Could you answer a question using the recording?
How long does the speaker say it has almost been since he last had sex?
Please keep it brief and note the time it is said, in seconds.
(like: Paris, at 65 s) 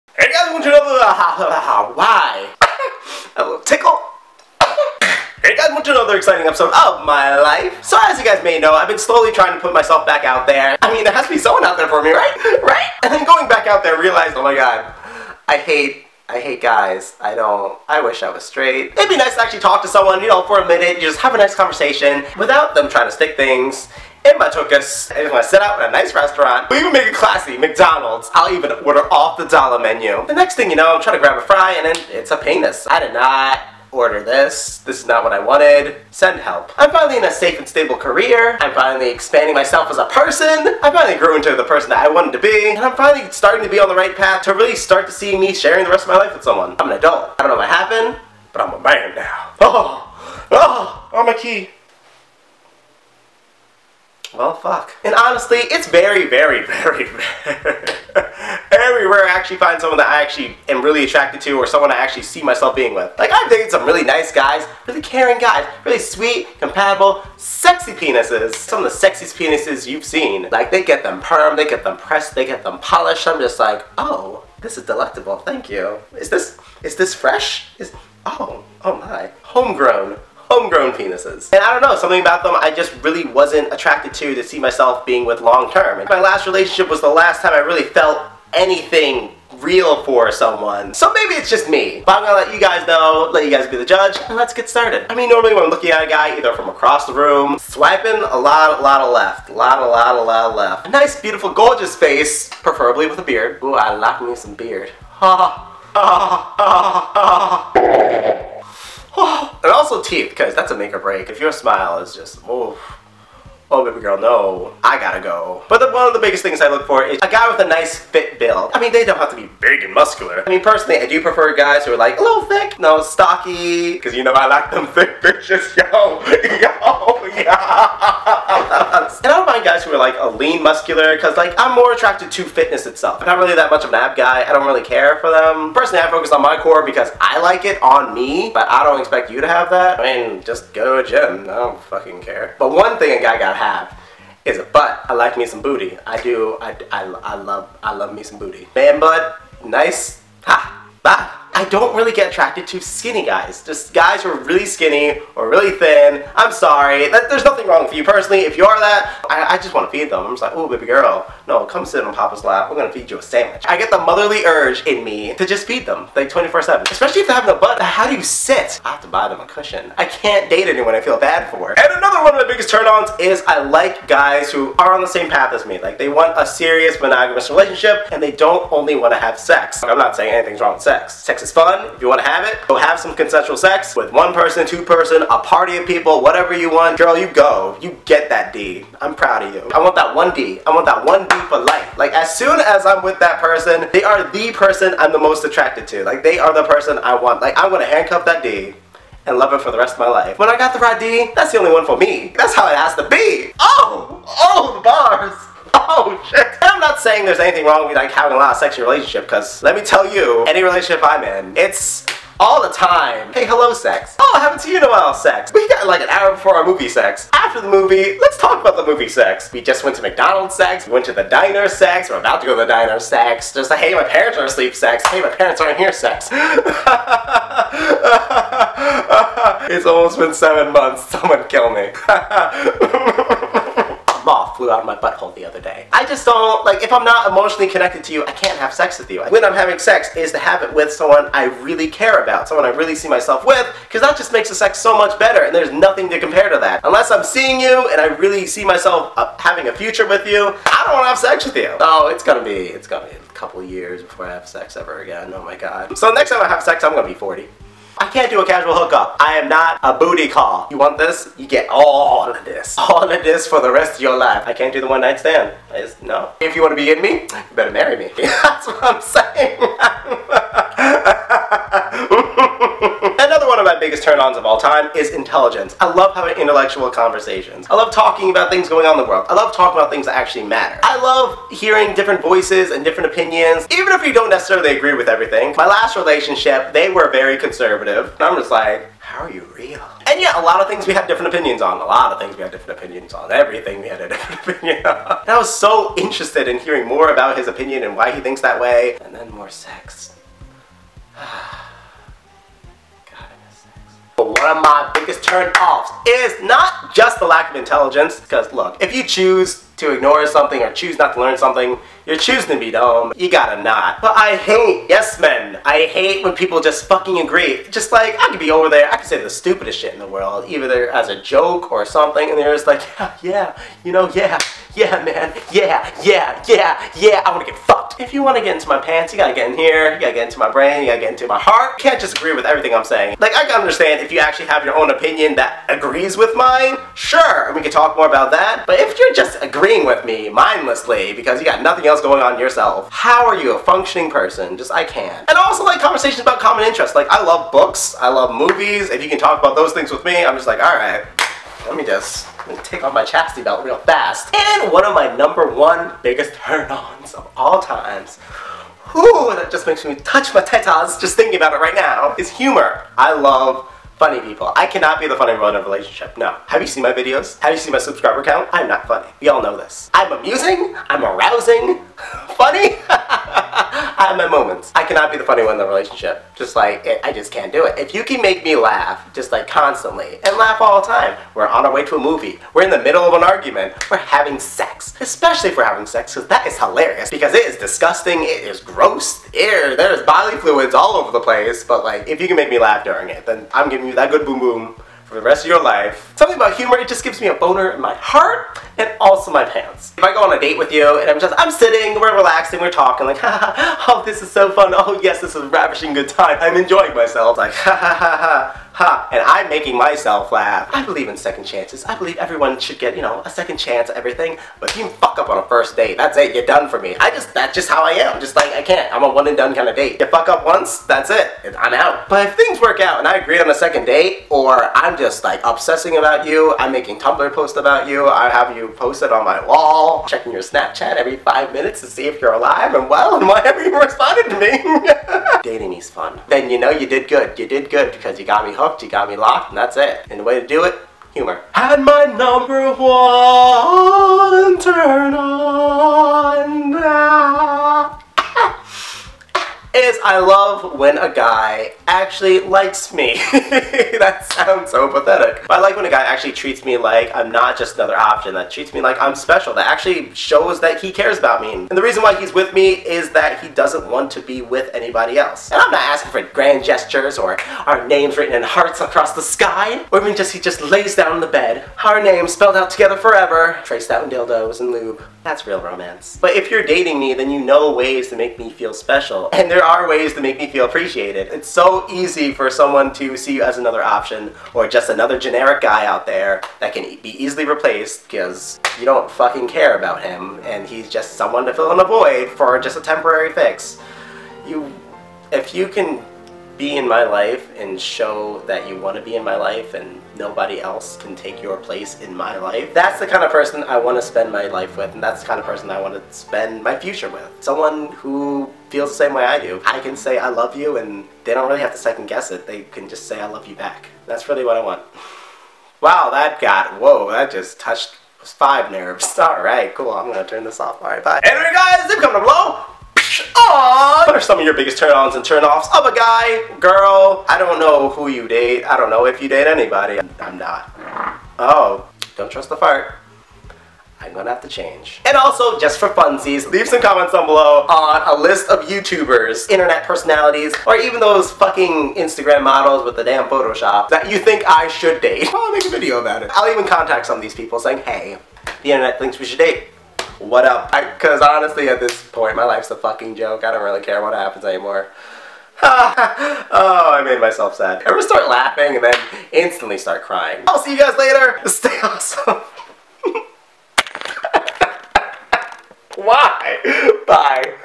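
7 months, at 230 s.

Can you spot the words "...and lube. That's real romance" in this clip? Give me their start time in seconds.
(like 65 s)
474 s.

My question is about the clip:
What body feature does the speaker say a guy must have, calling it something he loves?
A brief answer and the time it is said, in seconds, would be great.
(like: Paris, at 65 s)
A butt, at 144 s.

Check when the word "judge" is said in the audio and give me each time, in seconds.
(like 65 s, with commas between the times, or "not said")
93 s.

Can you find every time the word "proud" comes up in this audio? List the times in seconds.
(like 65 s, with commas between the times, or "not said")
189 s.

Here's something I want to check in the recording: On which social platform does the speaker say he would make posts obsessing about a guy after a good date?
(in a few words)
Tumblr.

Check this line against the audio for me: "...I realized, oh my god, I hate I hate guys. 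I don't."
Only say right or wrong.
right.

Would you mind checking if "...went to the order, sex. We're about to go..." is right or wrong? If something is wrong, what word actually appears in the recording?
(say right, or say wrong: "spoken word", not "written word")
wrong: "diner", not "order".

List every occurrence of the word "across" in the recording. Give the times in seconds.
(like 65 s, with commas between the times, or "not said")
96 s, 468 s.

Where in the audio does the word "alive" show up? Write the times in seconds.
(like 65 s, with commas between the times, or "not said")
432 s.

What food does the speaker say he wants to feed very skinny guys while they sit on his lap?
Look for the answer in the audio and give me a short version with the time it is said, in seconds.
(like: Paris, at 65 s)
A sandwich, at 163 s.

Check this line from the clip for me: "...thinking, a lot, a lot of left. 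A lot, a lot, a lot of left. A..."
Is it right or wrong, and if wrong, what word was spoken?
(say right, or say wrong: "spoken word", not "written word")
wrong: "swiping", not "thinking".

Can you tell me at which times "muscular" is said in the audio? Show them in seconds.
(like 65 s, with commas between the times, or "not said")
119 s, 130 s.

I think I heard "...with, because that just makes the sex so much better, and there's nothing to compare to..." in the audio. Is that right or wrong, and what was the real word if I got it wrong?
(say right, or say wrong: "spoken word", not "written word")
right.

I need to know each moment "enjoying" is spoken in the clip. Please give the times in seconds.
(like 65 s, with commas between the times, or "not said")
406 s.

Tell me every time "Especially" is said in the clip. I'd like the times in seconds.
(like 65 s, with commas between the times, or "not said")
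166 s, 384 s.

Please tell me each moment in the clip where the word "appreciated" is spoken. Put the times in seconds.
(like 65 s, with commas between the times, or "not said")
480 s.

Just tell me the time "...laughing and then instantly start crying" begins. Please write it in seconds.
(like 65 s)
558 s.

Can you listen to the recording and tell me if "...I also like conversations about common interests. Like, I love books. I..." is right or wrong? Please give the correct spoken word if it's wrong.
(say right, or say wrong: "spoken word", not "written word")
right.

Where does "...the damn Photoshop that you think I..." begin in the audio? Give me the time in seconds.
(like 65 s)
542 s.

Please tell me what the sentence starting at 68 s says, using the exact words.
Some of the sexiest penises you've seen.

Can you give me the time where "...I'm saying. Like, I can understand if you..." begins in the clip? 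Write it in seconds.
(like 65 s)
332 s.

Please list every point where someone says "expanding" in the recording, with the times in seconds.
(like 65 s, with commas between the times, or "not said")
39 s.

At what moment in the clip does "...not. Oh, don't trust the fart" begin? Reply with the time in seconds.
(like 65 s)
530 s.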